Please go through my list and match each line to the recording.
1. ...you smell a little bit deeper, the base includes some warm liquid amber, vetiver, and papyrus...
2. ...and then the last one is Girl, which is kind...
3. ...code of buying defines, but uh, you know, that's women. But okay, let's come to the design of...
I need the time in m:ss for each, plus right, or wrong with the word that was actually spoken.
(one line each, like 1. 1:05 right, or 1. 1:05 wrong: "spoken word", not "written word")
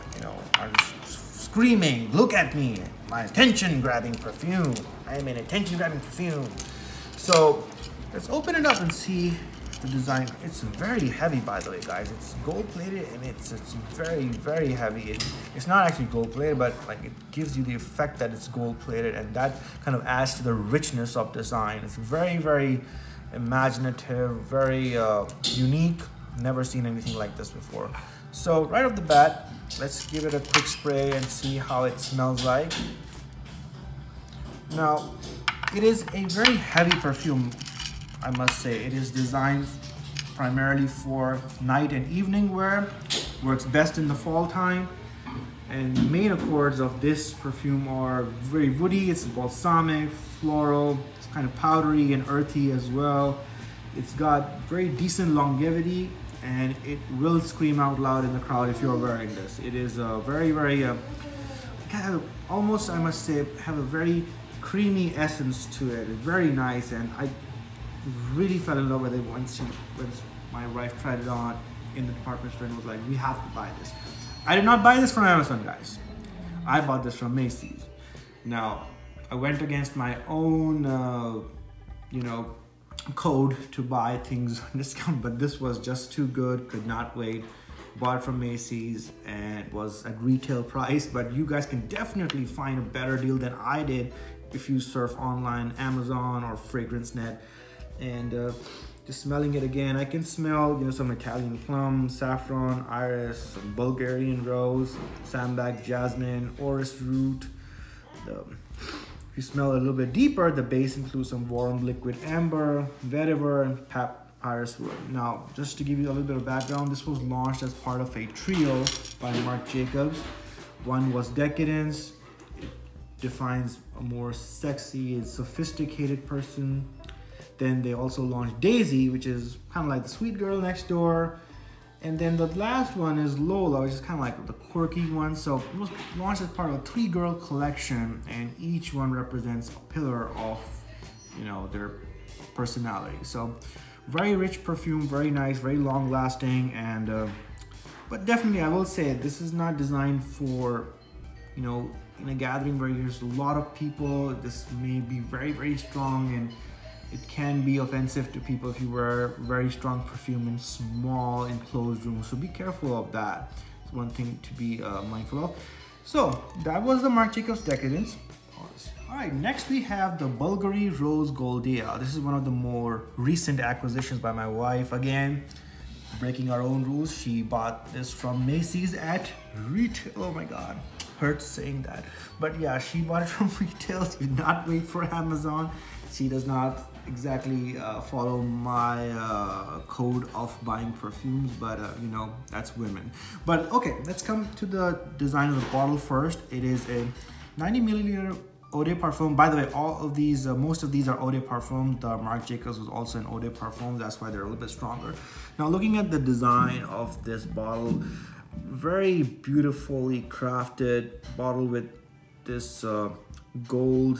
1. 1:49 right
2. 2:12 wrong: "Lola", not "Girl"
3. 3:09 wrong: "perfumes", not "defines".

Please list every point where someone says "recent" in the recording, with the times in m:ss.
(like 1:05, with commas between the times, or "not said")
2:53.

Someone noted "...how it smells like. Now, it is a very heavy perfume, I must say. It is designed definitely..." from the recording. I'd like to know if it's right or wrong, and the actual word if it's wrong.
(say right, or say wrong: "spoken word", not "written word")
wrong: "primarily", not "definitely".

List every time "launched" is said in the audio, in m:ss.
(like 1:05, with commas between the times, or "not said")
1:57, 2:08, 2:16.